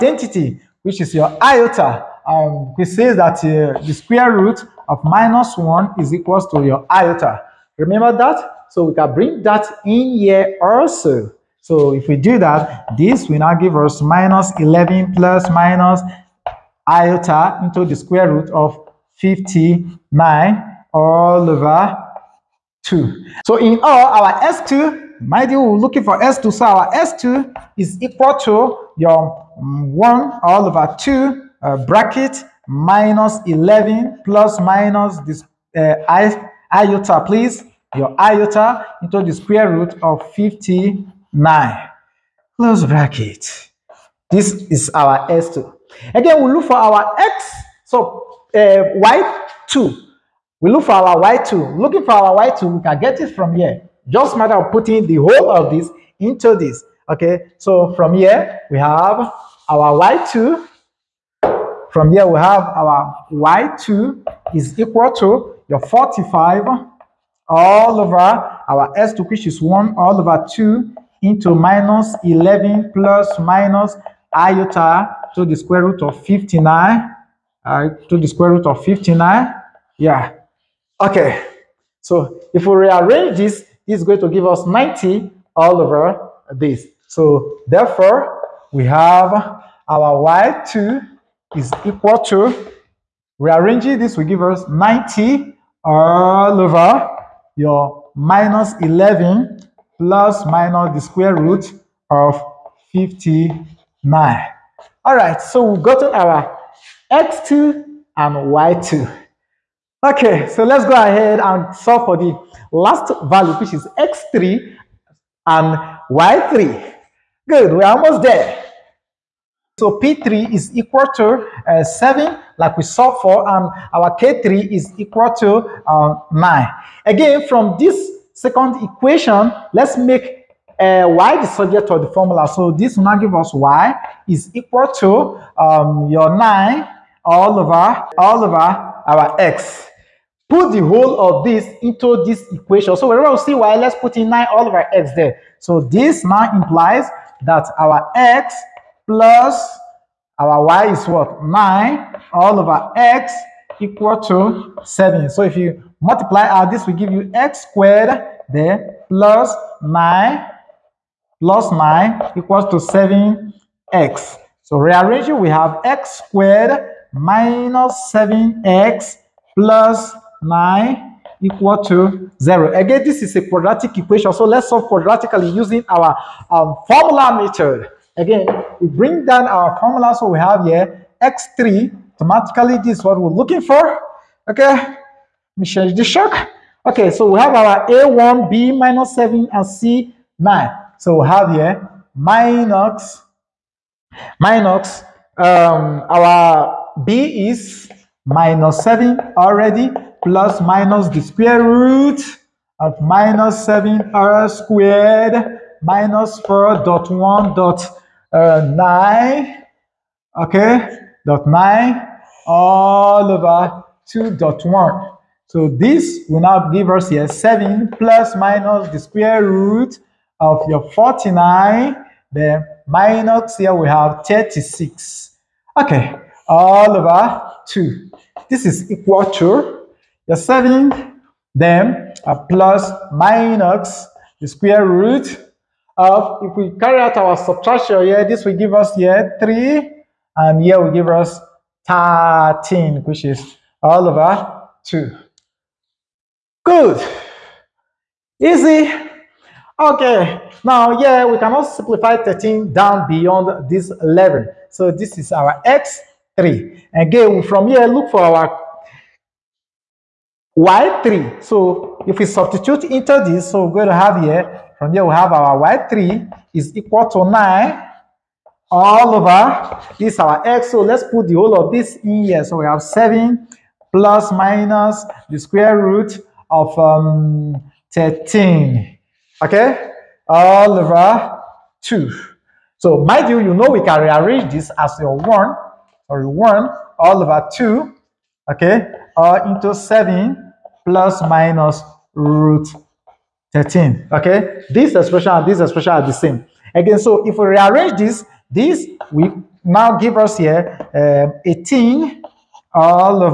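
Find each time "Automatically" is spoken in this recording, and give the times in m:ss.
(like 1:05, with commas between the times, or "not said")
3:02.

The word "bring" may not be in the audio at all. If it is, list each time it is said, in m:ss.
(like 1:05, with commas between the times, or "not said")
0:09, 2:58.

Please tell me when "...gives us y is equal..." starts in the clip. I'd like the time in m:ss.
2:13.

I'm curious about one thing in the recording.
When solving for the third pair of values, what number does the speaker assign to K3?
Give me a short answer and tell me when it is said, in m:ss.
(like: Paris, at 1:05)
9, at 2:04.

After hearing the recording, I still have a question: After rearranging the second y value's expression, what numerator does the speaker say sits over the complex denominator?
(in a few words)
90.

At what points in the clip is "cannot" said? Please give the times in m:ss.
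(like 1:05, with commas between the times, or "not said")
4:11.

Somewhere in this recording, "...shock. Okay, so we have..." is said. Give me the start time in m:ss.
3:06.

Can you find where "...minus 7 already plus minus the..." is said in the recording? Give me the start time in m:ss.
3:18.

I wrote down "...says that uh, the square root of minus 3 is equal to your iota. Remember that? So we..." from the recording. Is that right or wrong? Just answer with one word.
wrong.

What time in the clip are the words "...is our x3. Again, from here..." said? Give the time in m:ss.
4:15.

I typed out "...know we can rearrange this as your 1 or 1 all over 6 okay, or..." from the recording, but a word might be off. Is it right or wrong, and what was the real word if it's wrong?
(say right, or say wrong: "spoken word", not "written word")
wrong: "2", not "6".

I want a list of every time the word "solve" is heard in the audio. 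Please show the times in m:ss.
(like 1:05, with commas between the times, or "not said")
1:51, 2:54.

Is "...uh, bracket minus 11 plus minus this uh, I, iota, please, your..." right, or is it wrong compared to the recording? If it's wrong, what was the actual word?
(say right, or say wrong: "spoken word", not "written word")
right.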